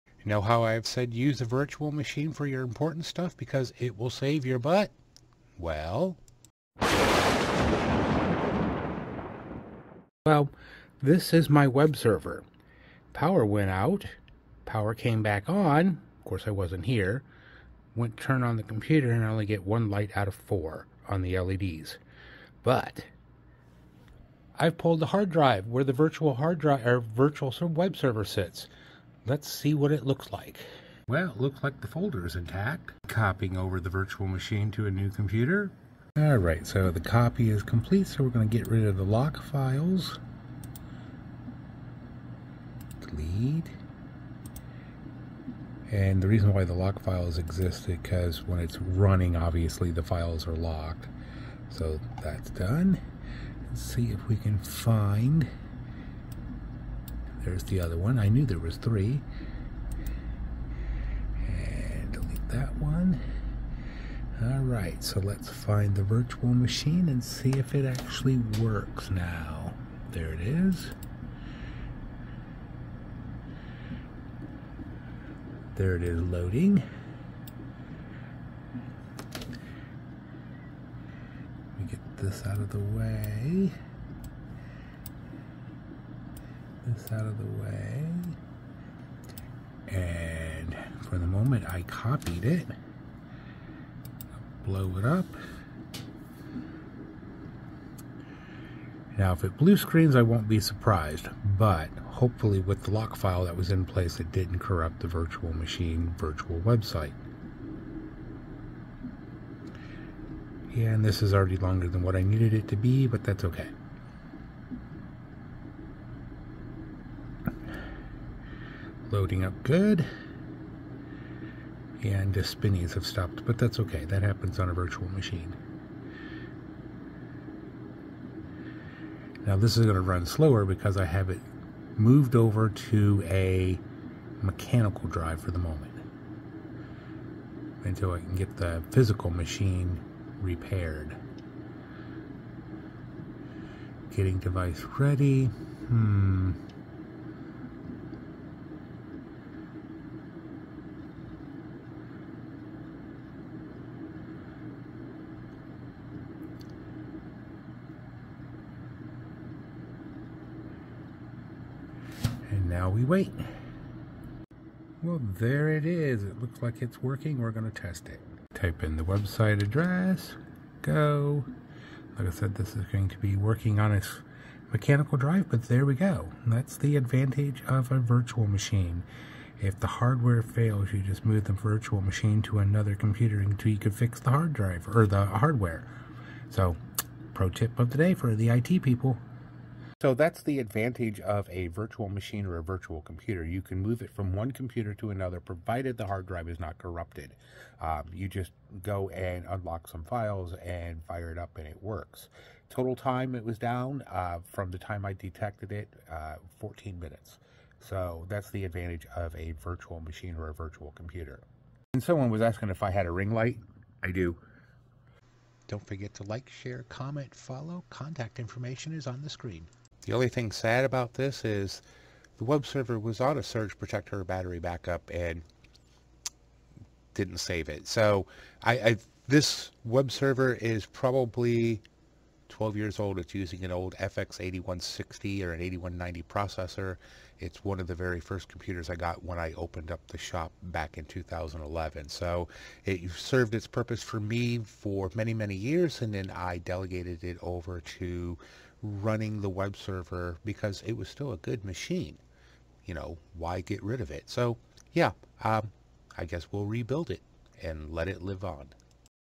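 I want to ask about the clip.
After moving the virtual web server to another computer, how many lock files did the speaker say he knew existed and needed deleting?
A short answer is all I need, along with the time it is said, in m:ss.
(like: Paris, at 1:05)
3, at 0:58.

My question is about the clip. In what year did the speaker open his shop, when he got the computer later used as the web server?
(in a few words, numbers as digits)
2011.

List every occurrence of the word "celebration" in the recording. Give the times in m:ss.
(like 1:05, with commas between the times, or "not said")
not said.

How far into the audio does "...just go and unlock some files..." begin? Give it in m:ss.
3:18.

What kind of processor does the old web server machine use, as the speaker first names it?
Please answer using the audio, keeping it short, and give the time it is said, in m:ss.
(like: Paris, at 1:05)
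FX8160, at 3:53.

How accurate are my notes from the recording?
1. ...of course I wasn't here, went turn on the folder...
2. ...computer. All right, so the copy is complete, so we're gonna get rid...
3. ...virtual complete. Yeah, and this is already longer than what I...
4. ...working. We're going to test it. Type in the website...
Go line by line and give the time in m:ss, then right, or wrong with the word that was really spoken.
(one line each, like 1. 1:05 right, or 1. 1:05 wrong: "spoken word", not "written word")
1. 0:16 wrong: "computer", not "folder"
2. 0:35 right
3. 1:46 wrong: "website", not "complete"
4. 2:47 right.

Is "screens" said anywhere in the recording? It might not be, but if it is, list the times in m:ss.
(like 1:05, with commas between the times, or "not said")
1:39, 3:39.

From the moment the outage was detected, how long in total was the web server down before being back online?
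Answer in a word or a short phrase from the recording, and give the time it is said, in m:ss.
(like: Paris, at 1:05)
14 minutes, at 3:26.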